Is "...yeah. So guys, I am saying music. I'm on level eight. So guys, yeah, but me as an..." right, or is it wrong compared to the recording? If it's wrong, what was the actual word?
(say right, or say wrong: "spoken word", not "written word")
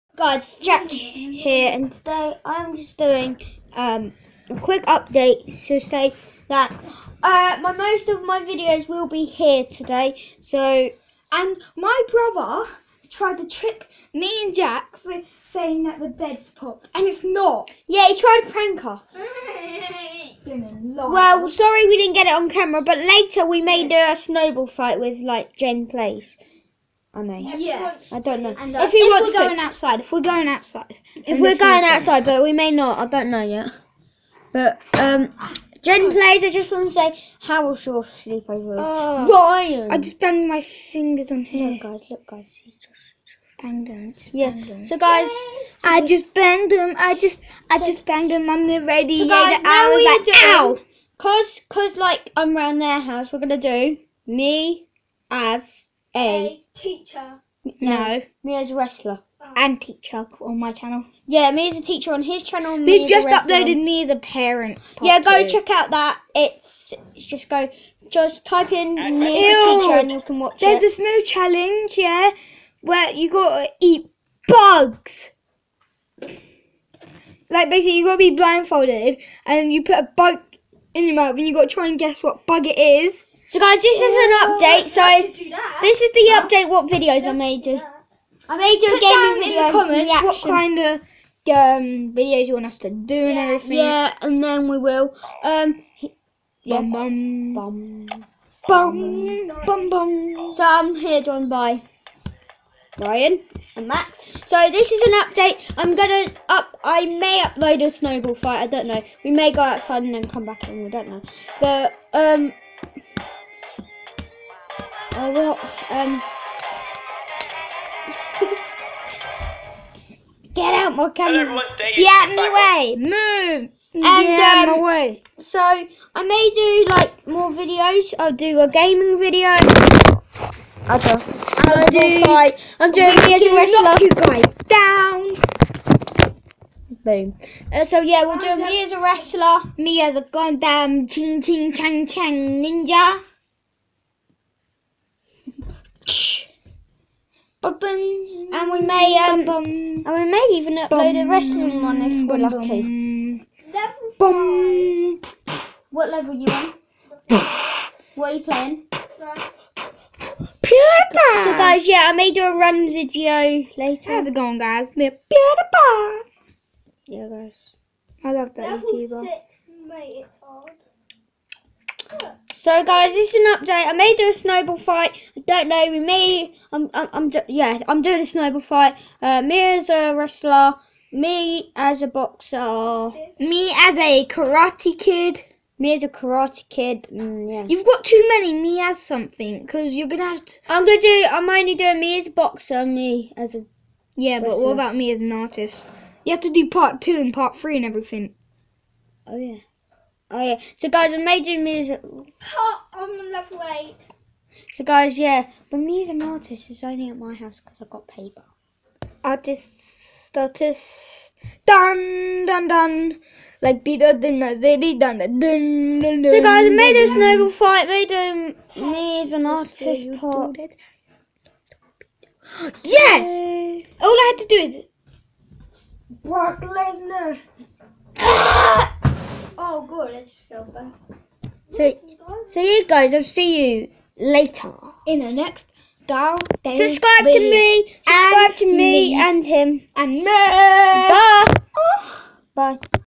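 wrong: "making", not "saying".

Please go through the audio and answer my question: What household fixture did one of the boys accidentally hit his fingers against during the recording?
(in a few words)
The radiator.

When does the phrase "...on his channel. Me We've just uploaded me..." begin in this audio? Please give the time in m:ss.
1:02.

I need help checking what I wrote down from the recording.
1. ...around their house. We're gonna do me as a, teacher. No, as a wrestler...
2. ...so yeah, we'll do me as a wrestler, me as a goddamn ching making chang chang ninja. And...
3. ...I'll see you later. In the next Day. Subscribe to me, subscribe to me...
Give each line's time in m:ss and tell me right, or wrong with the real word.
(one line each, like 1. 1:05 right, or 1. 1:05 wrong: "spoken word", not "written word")
1. 0:52 right
2. 2:17 wrong: "ching", not "making"
3. 3:53 right.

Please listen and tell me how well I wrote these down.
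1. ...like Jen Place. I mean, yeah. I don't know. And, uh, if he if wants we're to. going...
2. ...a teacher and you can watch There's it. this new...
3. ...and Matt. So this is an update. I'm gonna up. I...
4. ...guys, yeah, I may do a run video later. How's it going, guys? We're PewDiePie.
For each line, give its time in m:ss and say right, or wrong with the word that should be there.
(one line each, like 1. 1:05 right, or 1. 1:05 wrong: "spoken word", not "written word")
1. 0:25 right
2. 1:09 right
3. 1:43 right
4. 2:41 right.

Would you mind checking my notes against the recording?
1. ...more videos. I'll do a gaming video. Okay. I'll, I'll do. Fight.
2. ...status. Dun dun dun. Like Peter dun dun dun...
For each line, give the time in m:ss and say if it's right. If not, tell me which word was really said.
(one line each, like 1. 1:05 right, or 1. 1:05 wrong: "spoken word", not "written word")
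1. 2:07 right
2. 3:30 right.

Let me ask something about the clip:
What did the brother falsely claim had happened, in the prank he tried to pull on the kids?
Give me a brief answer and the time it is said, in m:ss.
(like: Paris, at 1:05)
The bed popped, at 0:15.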